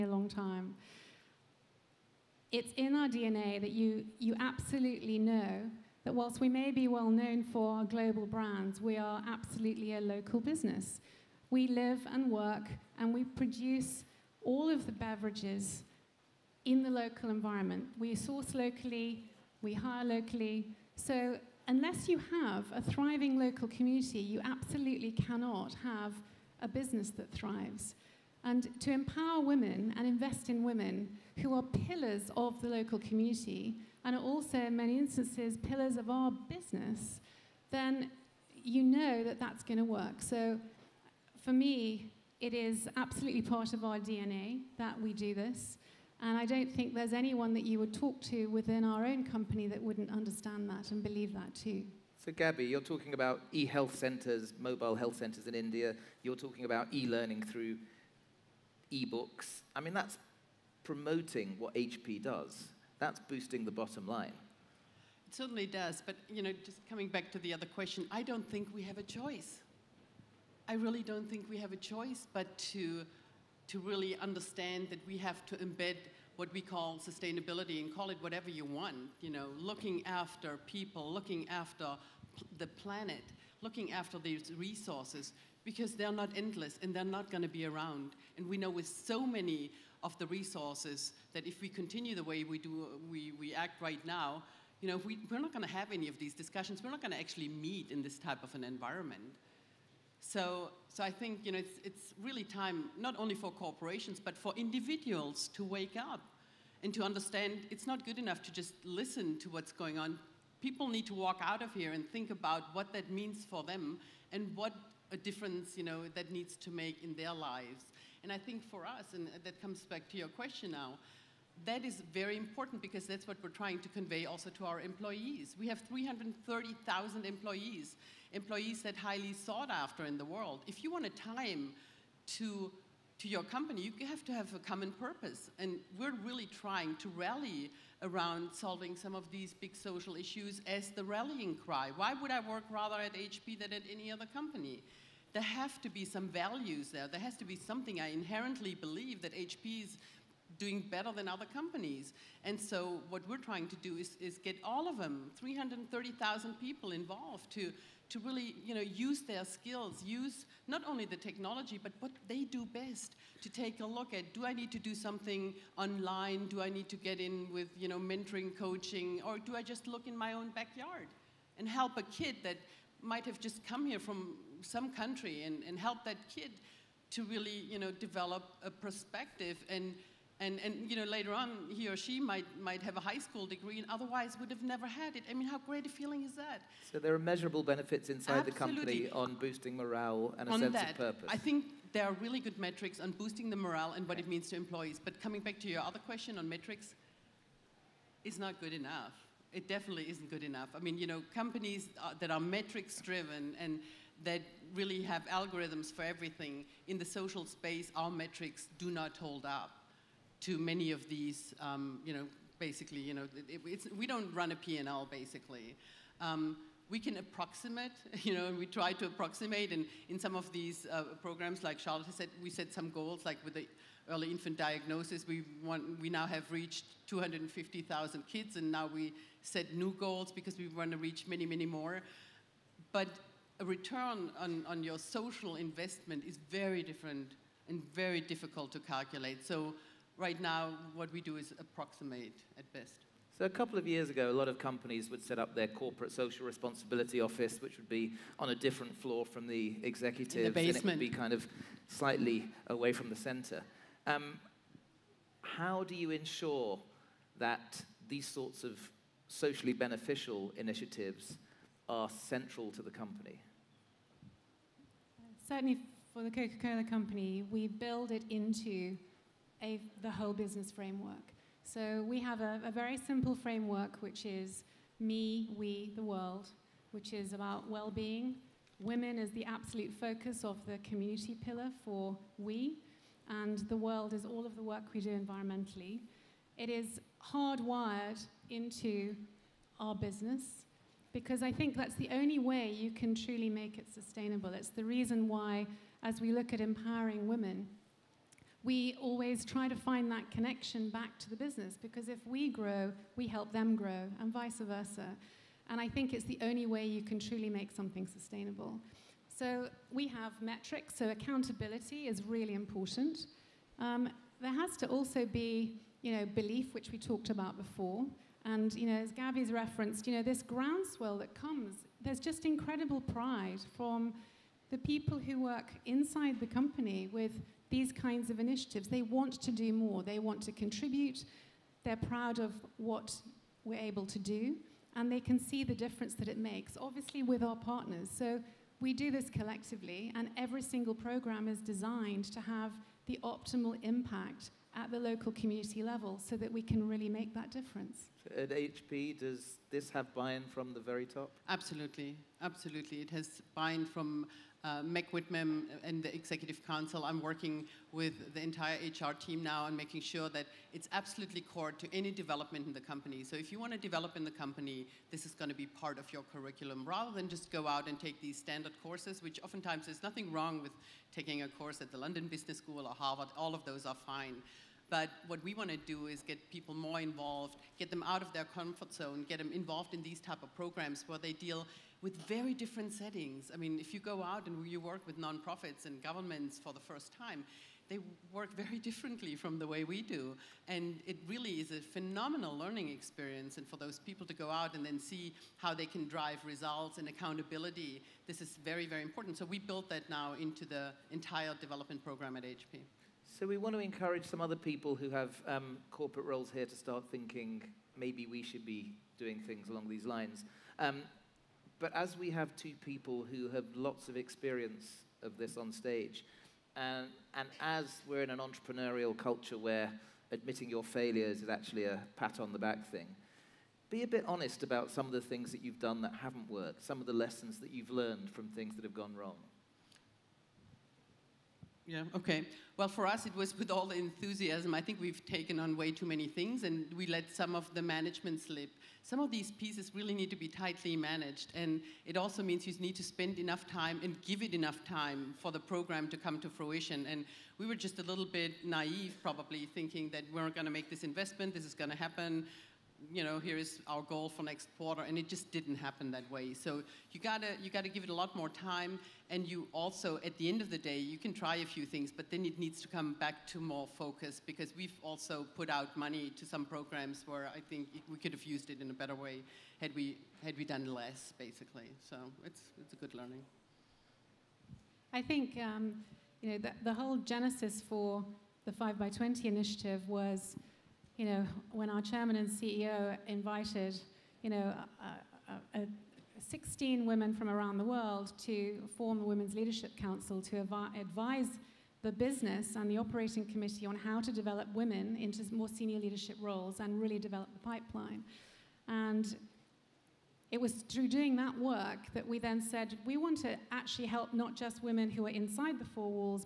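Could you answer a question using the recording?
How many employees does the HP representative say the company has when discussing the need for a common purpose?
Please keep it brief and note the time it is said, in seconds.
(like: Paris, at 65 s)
330,000, at 125 s.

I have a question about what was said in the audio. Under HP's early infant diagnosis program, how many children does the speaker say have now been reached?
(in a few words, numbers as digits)
250,000.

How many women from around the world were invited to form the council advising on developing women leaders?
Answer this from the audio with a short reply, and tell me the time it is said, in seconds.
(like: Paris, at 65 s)
16, at 486 s.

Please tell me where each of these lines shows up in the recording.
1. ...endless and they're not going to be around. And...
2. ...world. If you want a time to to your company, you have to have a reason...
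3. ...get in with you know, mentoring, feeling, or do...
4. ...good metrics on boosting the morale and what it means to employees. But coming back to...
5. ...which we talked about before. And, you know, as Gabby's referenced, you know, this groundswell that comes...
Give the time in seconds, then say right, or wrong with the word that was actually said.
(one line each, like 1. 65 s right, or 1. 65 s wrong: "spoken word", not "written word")
1. 86 s right
2. 130 s wrong: "common", not "reason"
3. 166 s wrong: "coaching", not "feeling"
4. 192 s right
5. 316 s right.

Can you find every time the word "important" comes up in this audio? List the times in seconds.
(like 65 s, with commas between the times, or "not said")
122 s, 312 s, 399 s.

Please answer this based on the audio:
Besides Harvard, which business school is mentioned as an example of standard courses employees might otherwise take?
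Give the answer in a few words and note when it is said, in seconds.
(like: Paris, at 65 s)
London Business School, at 371 s.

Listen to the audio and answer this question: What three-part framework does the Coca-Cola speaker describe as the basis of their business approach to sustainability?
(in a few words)
me, we, the world.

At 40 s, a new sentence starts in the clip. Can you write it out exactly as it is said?
So, for me, it is absolutely part of our DNA that we do this.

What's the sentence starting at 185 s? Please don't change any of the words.
I mean, how great a feeling is that?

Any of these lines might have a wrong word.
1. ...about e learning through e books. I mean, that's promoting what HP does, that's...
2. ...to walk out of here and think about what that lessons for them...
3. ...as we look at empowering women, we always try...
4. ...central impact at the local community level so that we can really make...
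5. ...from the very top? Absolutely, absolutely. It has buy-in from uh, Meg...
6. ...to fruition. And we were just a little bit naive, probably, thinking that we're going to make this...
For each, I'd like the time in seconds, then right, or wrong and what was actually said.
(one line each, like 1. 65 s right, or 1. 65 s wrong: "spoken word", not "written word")
1. 56 s right
2. 111 s wrong: "means", not "lessons"
3. 296 s right
4. 343 s wrong: "optimal", not "central"
5. 350 s right
6. 446 s right.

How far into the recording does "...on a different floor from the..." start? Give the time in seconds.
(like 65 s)
248 s.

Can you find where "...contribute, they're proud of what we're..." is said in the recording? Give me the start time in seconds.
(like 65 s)
330 s.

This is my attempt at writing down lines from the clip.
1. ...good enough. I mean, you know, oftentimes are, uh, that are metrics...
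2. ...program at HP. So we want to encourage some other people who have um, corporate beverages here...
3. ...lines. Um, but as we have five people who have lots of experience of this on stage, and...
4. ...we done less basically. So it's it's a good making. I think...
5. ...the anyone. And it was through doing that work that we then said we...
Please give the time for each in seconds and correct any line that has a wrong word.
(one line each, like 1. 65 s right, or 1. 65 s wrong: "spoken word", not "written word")
1. 200 s wrong: "companies", not "oftentimes"
2. 402 s wrong: "roles", not "beverages"
3. 410 s wrong: "two", not "five"
4. 470 s wrong: "learning", not "making"
5. 497 s wrong: "pipeline", not "anyone".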